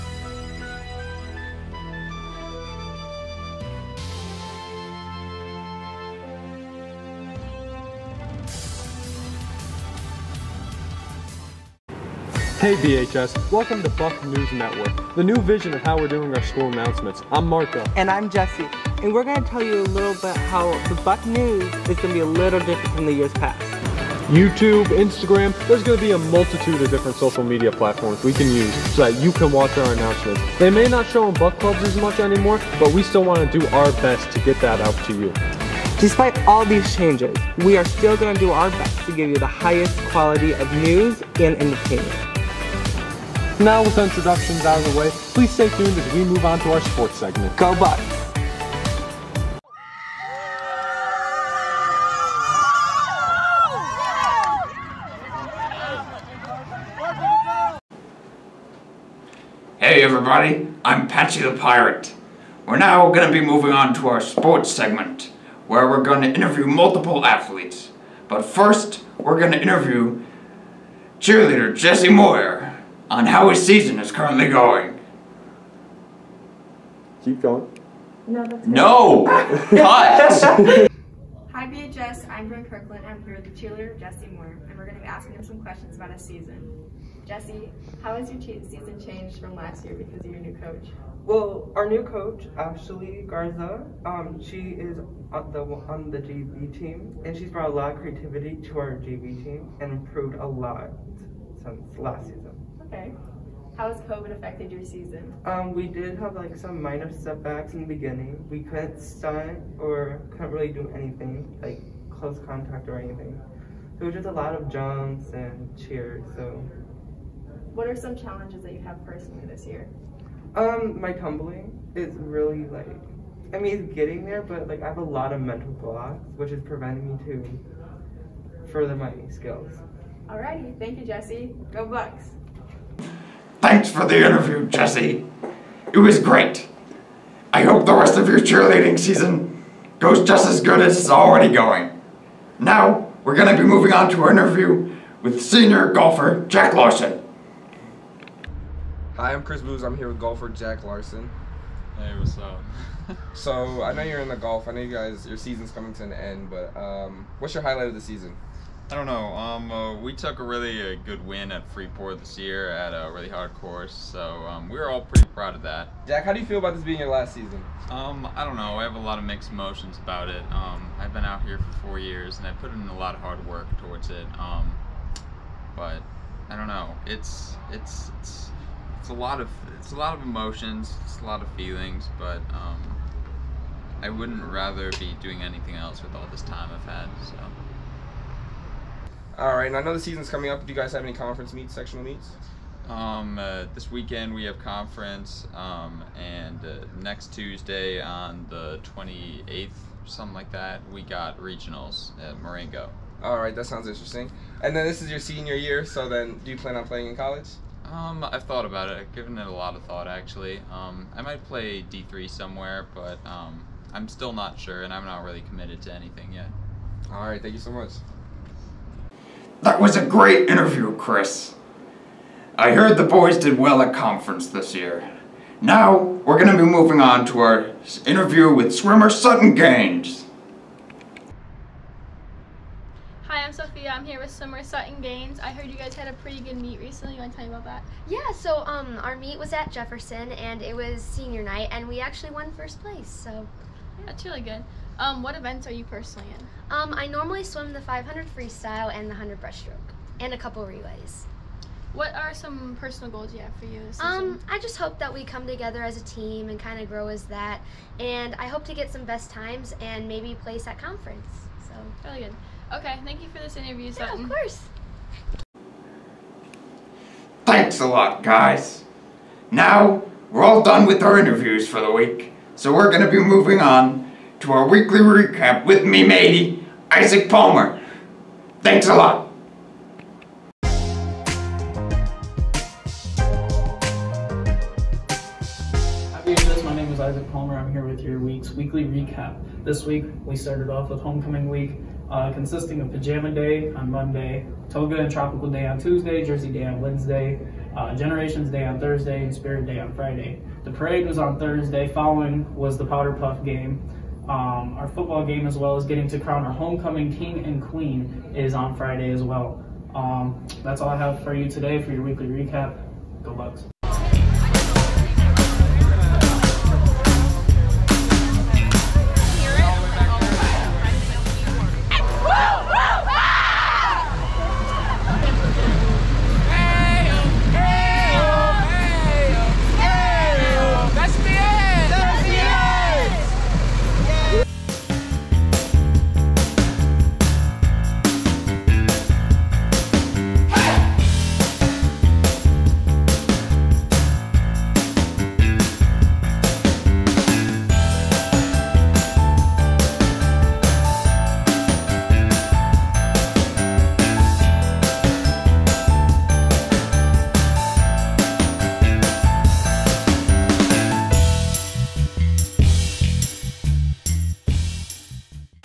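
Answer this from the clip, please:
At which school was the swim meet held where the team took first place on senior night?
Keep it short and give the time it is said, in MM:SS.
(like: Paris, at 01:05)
Jefferson, at 03:59.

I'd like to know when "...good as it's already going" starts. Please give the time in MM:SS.
02:20.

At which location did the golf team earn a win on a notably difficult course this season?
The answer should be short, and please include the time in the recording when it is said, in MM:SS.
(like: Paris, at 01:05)
Freeport, at 02:41.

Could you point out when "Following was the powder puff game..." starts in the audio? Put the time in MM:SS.
05:01.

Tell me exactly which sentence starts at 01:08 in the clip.
But first, we're going to interview cheerleader Jessie Moyer on how his season is currently going.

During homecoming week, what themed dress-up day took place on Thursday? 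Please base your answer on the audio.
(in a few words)
Generations day.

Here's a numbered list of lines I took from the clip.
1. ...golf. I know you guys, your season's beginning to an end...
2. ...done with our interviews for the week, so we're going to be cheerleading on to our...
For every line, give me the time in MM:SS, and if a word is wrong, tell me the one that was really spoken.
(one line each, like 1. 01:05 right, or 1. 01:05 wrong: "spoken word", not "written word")
1. 02:34 wrong: "coming", not "beginning"
2. 04:30 wrong: "moving", not "cheerleading".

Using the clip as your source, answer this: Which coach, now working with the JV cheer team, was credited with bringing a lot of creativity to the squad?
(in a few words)
Ashley Garza.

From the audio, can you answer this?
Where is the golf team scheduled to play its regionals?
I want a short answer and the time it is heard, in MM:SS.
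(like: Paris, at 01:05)
Marengo, at 03:22.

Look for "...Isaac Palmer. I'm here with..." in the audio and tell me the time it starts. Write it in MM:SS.
04:47.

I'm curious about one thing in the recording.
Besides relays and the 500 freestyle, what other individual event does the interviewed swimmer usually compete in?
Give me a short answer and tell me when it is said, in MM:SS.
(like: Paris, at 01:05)
100 breaststroke, at 04:09.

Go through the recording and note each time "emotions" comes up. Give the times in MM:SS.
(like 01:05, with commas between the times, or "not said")
02:49, 03:00.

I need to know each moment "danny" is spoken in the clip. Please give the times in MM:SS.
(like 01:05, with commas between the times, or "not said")
not said.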